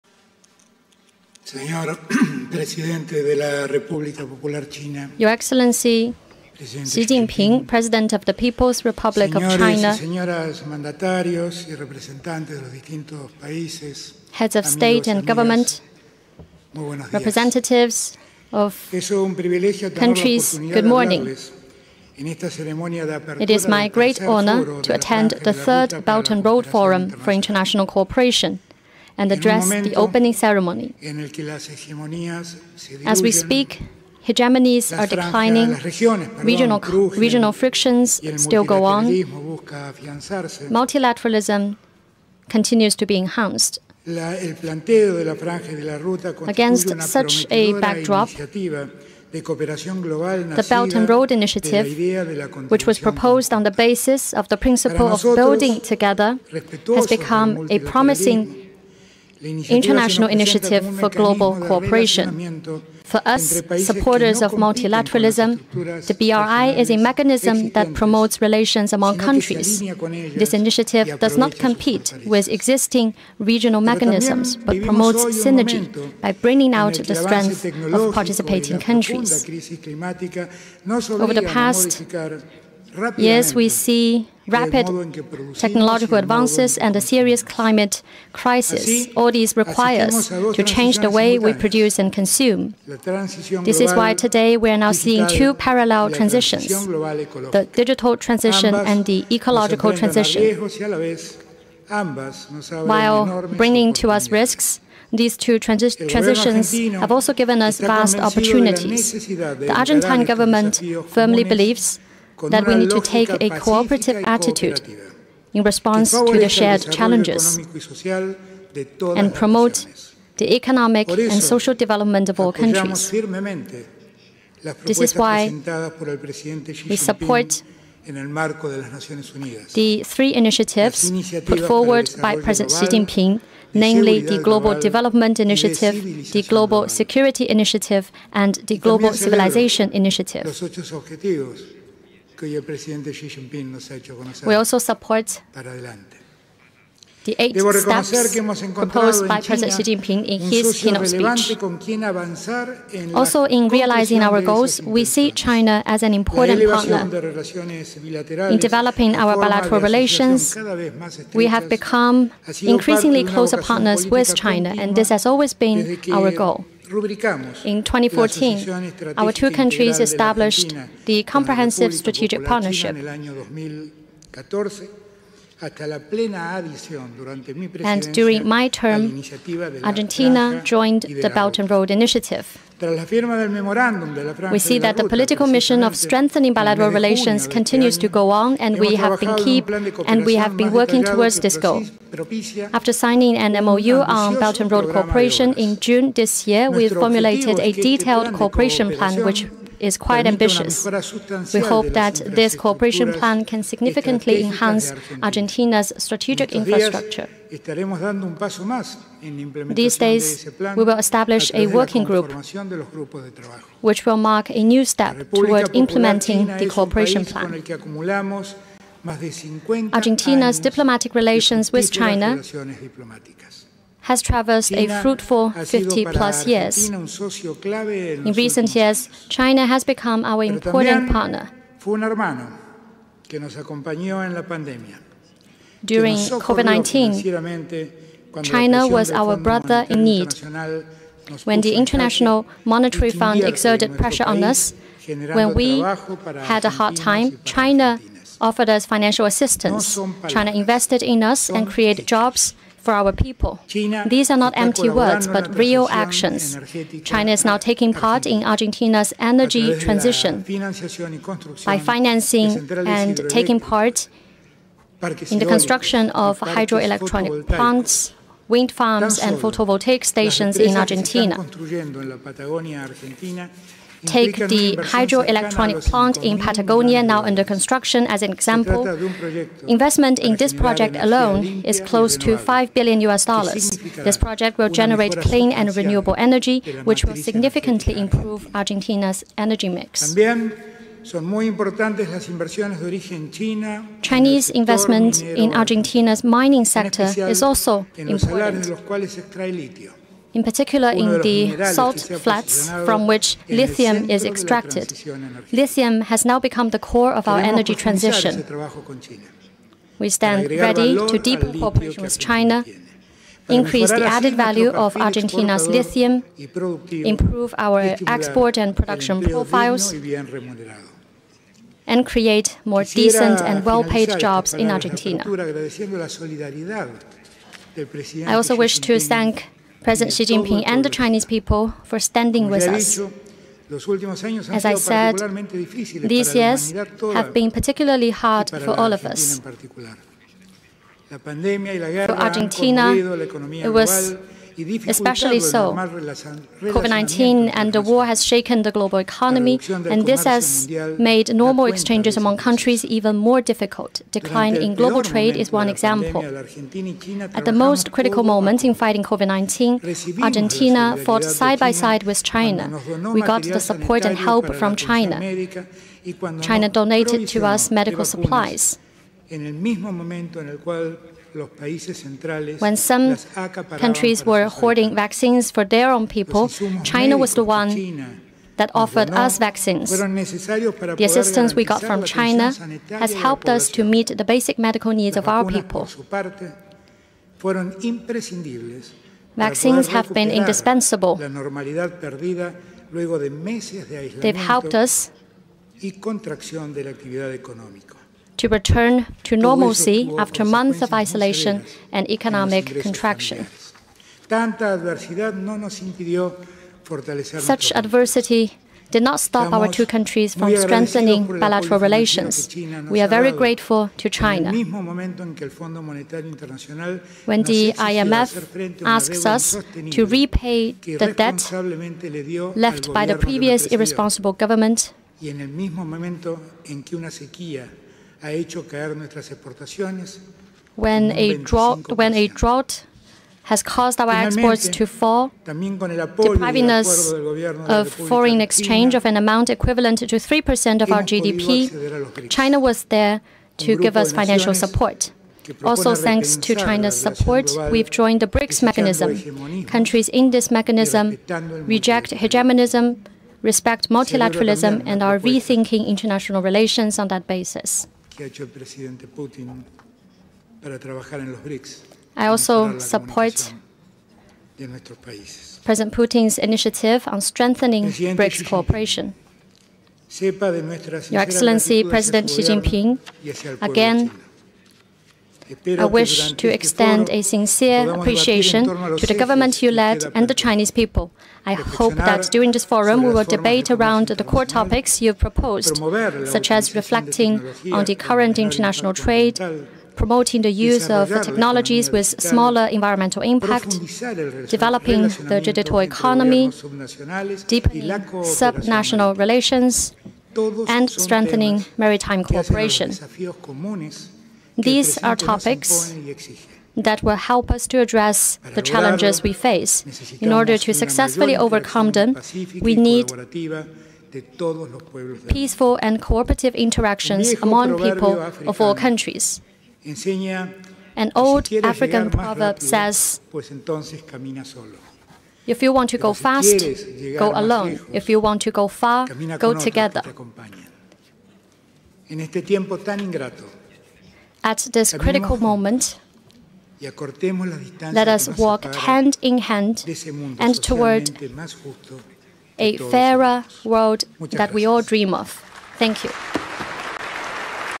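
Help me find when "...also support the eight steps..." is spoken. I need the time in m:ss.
2:24.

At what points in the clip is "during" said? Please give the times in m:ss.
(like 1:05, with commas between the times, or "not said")
2:58, 3:55, 8:02.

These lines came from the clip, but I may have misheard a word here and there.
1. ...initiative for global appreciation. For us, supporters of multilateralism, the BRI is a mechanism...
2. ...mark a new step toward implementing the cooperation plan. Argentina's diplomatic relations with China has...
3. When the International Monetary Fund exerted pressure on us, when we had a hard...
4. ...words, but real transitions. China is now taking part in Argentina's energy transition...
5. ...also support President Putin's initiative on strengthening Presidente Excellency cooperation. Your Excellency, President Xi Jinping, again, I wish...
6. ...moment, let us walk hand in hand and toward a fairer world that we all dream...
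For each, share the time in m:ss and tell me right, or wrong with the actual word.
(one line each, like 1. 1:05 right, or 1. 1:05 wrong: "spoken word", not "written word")
1. 1:00 wrong: "cooperation", not "appreciation"
2. 3:34 right
3. 4:01 right
4. 4:14 wrong: "actions", not "transitions"
5. 7:42 wrong: "BRICS", not "Excellency"
6. 8:55 right.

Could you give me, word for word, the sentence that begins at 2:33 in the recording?
Also, in realizing our goals, we see China as an important partner.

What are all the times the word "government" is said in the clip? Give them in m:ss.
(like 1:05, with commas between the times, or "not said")
0:15, 1:50, 7:04, 7:59.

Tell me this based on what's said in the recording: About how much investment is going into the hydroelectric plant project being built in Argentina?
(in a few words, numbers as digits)
close to 5 billion US dollars.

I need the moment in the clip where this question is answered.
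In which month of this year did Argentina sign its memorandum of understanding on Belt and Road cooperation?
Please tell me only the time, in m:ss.
3:15.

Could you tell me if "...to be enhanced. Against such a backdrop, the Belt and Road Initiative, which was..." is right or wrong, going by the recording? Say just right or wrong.
right.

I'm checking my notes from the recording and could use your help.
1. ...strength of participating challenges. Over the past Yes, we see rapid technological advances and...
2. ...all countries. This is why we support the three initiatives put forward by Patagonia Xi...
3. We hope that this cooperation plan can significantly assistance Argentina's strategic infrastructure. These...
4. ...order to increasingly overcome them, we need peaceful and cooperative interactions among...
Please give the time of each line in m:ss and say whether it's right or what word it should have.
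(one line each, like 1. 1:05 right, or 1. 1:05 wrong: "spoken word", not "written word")
1. 1:17 wrong: "countries", not "challenges"
2. 2:02 wrong: "President", not "Patagonia"
3. 3:21 wrong: "enhance", not "assistance"
4. 8:30 wrong: "successfully", not "increasingly".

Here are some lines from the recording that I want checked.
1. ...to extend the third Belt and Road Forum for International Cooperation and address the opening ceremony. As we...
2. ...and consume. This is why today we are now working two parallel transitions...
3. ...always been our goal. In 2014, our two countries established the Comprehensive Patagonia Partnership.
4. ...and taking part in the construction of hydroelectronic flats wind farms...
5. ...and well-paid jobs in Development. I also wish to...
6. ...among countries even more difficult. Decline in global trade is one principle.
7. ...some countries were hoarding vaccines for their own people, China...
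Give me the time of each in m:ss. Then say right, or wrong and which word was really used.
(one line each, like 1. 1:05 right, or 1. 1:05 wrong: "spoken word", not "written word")
1. 0:24 wrong: "attend", not "extend"
2. 1:31 wrong: "seeing", not "working"
3. 2:45 wrong: "Strategic", not "Patagonia"
4. 4:22 wrong: "plants", not "flats"
5. 5:23 wrong: "Argentina", not "Development"
6. 5:52 wrong: "example", not "principle"
7. 6:12 right.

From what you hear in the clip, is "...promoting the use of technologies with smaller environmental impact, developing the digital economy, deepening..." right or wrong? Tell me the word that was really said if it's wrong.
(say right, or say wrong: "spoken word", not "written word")
right.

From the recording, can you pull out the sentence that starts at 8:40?
An old African proverb says, if you want to go fast, go alone.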